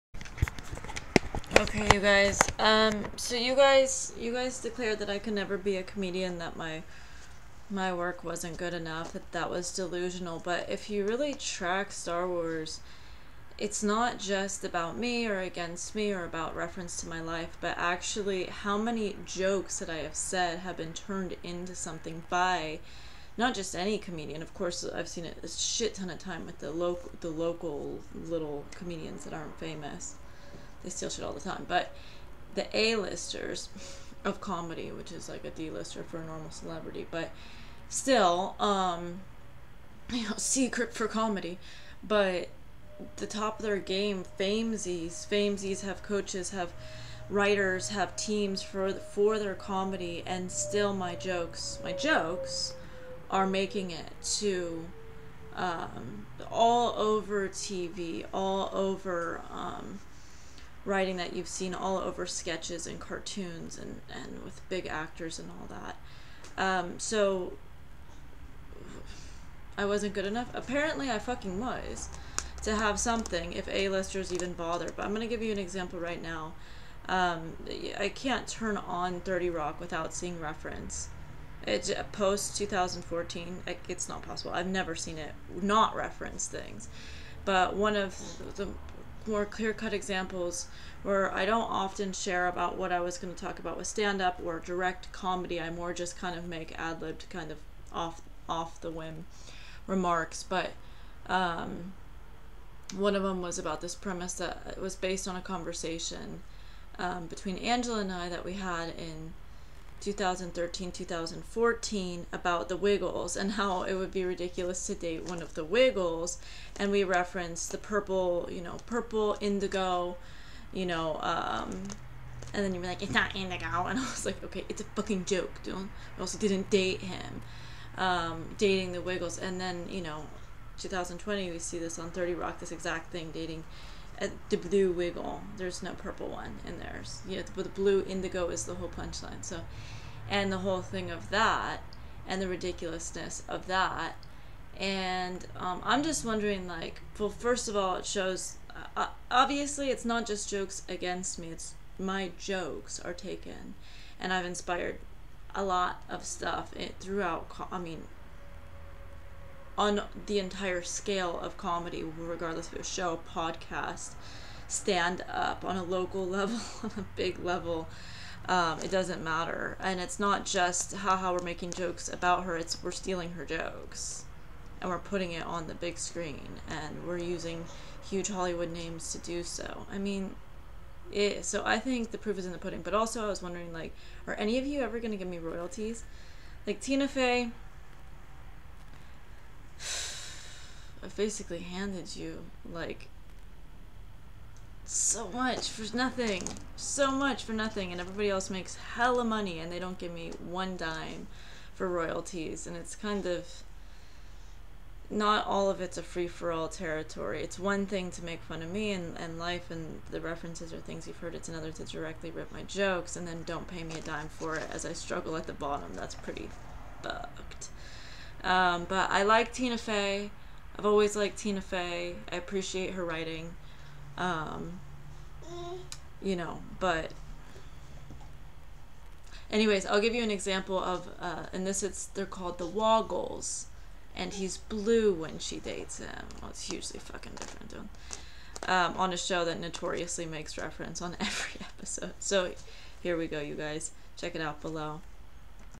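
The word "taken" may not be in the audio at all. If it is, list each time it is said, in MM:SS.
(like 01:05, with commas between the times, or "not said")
02:33.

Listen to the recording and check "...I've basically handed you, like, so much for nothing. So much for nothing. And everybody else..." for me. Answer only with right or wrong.
right.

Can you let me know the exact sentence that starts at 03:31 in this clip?
It's another to directly rip my jokes and then don't pay me a dime for it as I struggle at the bottom.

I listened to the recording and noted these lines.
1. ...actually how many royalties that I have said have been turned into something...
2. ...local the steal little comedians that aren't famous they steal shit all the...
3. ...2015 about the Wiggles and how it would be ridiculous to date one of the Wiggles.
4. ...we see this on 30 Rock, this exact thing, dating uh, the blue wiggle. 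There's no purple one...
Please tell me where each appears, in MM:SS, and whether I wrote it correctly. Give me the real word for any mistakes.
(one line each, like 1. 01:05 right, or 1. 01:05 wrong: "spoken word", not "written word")
1. 00:17 wrong: "jokes", not "royalties"
2. 00:26 wrong: "local", not "steal"
3. 01:50 wrong: "2014", not "2015"
4. 02:11 right.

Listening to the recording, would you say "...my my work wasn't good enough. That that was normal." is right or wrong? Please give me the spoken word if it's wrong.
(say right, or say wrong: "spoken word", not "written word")
wrong: "delusional", not "normal".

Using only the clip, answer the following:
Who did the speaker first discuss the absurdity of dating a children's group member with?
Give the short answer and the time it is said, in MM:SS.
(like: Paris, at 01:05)
Angela, at 01:47.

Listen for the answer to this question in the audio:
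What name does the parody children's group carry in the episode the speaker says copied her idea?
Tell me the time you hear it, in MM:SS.
03:52.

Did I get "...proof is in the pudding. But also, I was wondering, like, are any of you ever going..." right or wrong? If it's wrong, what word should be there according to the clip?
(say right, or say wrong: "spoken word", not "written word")
right.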